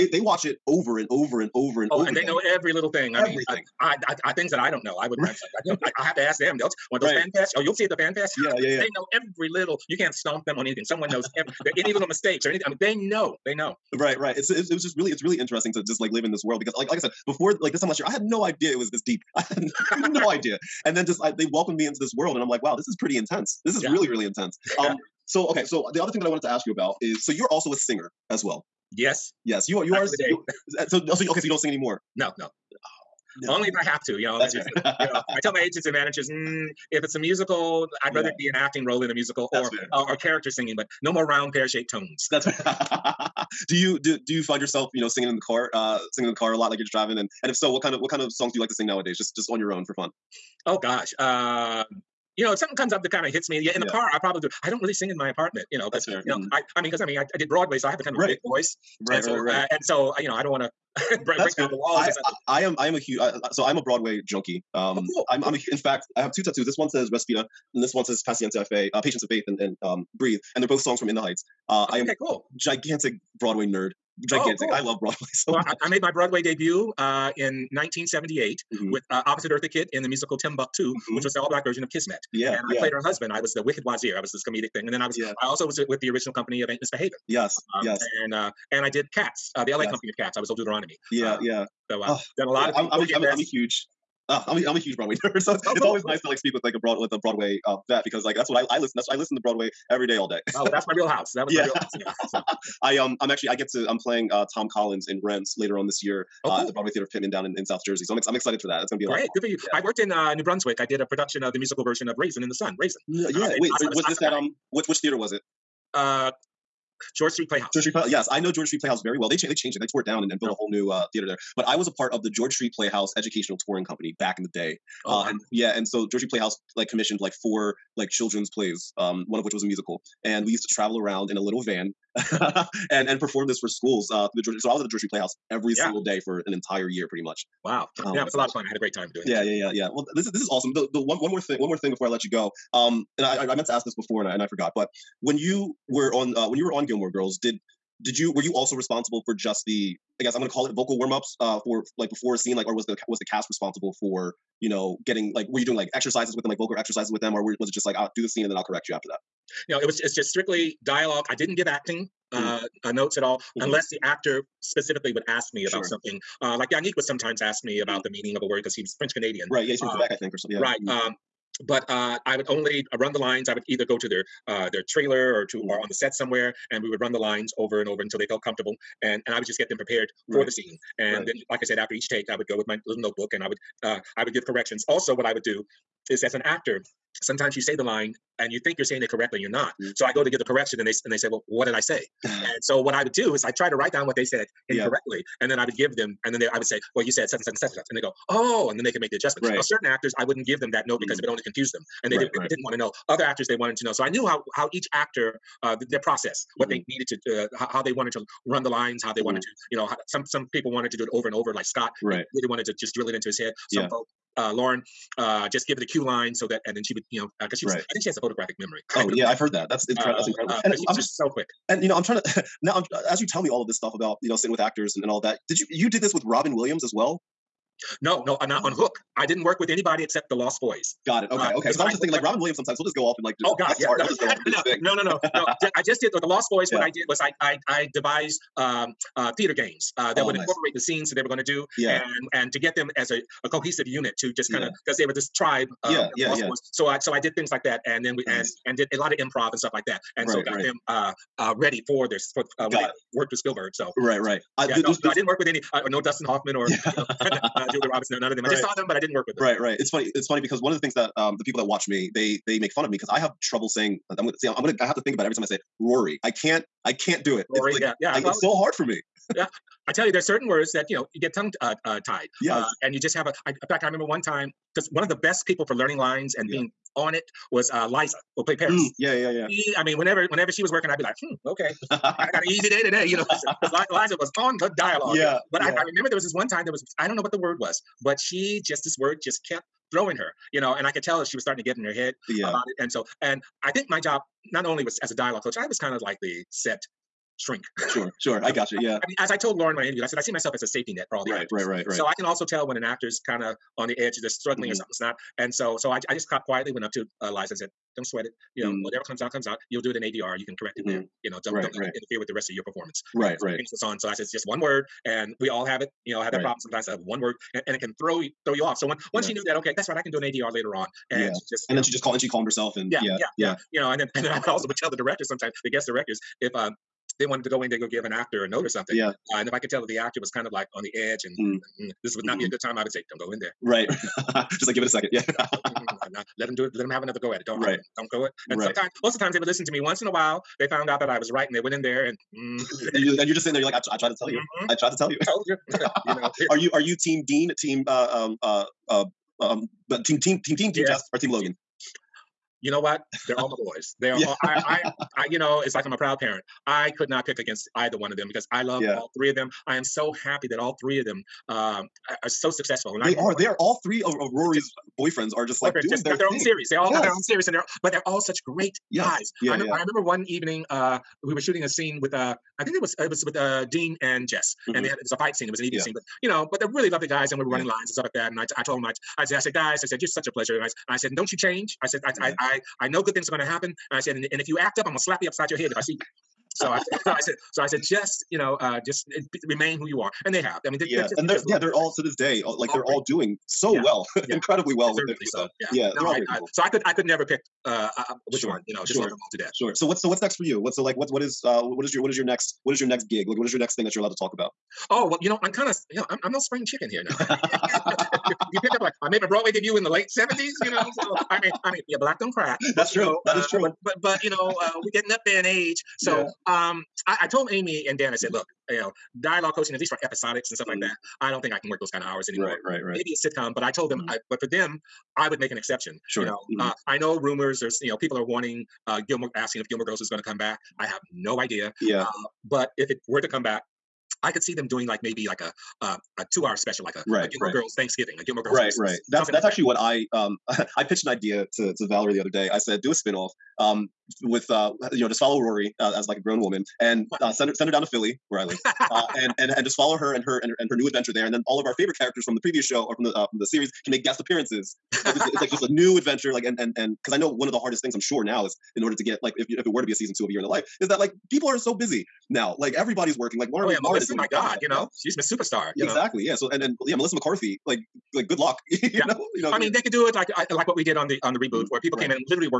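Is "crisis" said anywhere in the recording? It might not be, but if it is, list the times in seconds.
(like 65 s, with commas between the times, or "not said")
not said.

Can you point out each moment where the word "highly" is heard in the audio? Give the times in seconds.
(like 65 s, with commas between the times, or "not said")
not said.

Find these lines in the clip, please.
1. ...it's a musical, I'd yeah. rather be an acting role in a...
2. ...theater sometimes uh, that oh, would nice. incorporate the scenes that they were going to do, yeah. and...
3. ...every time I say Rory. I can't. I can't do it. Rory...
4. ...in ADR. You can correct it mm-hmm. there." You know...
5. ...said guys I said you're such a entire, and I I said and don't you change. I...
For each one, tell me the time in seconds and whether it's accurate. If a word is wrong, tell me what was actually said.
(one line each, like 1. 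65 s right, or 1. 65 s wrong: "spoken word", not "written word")
1. 37 s right
2. 239 s wrong: "games", not "sometimes"
3. 265 s right
4. 309 s right
5. 379 s wrong: "pleasure", not "entire".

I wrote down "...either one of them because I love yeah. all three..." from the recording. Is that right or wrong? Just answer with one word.
right.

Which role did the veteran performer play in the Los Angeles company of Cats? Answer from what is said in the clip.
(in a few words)
Old Deuteronomy.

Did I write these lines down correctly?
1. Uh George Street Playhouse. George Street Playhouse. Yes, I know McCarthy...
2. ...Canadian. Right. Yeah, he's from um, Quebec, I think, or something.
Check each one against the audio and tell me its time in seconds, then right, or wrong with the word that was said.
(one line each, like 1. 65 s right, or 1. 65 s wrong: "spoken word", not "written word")
1. 115 s wrong: "George", not "McCarthy"
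2. 169 s right.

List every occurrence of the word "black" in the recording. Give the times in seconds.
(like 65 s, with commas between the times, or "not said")
81 s, 411 s.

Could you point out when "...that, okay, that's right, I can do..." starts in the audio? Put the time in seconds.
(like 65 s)
319 s.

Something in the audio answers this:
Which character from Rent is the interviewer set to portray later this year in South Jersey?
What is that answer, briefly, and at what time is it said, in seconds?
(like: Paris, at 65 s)
Tom Collins, at 104 s.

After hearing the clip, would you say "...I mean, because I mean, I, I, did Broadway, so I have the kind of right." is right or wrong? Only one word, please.
right.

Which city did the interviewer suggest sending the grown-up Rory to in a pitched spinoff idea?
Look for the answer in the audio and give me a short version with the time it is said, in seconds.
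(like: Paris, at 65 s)
Philly, at 447 s.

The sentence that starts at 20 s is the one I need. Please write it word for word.
And then just I, they welcomed me into this world, and I'm like, wow, this is pretty intense.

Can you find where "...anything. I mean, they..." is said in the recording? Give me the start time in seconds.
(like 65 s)
12 s.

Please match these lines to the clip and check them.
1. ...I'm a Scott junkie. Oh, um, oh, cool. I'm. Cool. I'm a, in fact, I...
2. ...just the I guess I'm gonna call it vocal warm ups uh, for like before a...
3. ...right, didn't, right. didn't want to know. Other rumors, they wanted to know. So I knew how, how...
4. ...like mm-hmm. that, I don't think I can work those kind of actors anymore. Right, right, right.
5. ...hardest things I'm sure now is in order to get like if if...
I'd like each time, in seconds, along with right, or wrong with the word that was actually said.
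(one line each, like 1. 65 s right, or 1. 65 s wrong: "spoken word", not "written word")
1. 63 s wrong: "Broadway", not "Scott"
2. 149 s right
3. 202 s wrong: "actors", not "rumors"
4. 420 s wrong: "hours", not "actors"
5. 457 s right.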